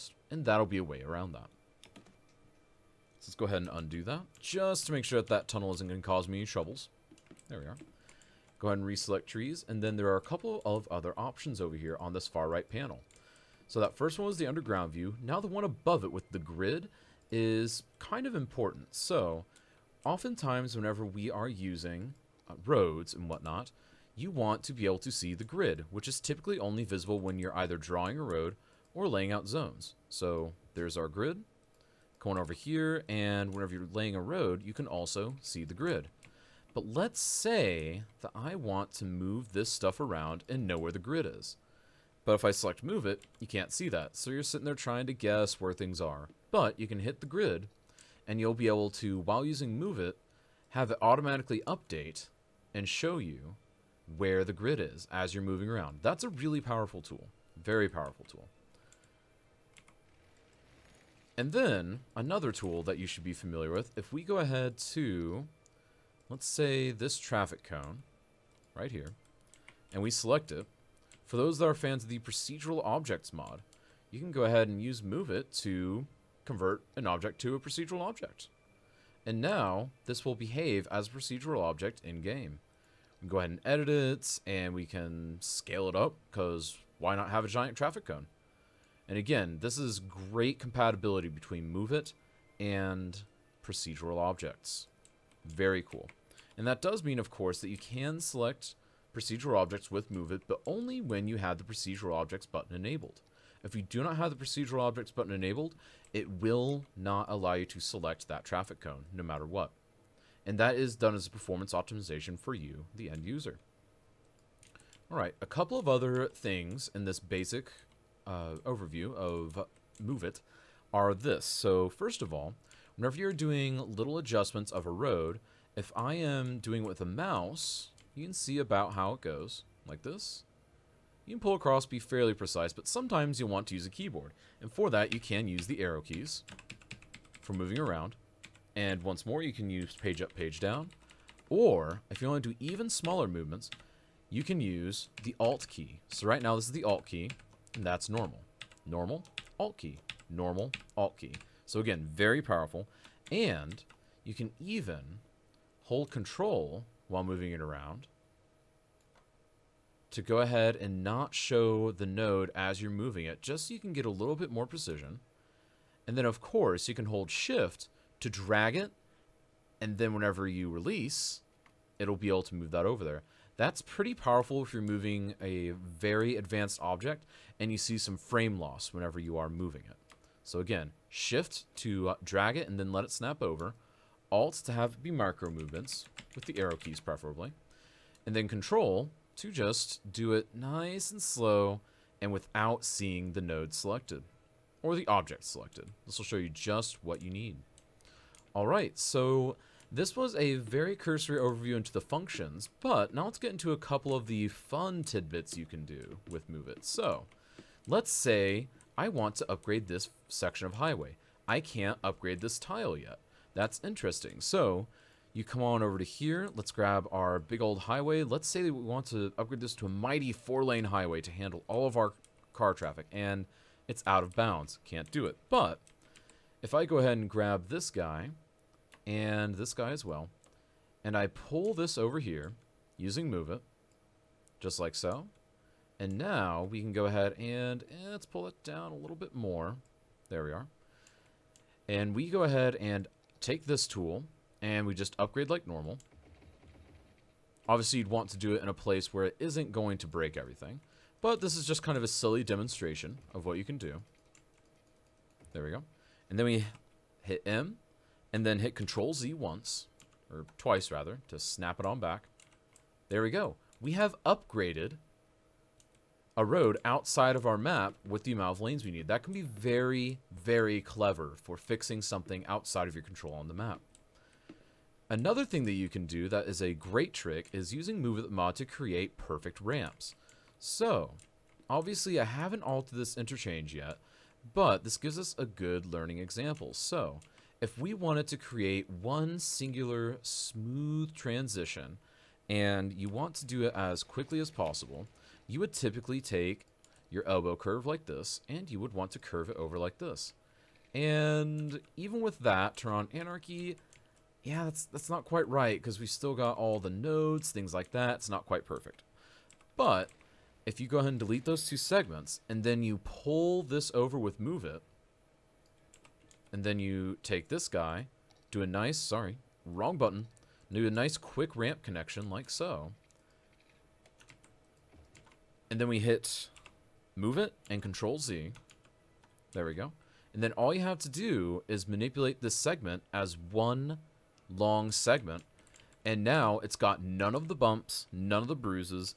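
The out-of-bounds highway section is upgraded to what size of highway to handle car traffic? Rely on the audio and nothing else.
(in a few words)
four-lane.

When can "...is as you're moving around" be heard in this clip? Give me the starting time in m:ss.
0:54.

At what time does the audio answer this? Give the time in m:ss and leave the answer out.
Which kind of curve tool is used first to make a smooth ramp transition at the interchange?
4:57.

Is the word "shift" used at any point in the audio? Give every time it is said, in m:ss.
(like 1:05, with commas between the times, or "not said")
2:47, 3:01.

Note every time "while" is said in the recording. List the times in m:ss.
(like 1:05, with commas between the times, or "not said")
0:49, 2:37.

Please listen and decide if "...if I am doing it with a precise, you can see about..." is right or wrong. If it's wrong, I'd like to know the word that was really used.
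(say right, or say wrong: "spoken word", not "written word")
wrong: "mouse", not "precise".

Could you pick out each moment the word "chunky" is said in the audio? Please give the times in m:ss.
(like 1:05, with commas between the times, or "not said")
not said.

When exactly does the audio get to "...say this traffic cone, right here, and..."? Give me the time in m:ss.
1:06.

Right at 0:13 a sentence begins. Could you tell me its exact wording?
So that first one was the underground view.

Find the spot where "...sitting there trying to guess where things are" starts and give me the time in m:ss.
0:44.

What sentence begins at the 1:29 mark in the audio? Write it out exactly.
And again, this is great compatibility between move it and procedural objects.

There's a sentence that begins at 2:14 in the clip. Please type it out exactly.
And for that, you can use the arrow keys for moving around.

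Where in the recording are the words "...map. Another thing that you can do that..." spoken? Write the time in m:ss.
4:33.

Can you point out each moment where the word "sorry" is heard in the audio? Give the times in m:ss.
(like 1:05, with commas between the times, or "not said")
5:18.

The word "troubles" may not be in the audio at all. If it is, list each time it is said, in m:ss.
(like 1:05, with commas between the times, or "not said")
0:06.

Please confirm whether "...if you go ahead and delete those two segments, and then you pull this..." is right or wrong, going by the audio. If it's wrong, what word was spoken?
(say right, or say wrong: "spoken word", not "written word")
right.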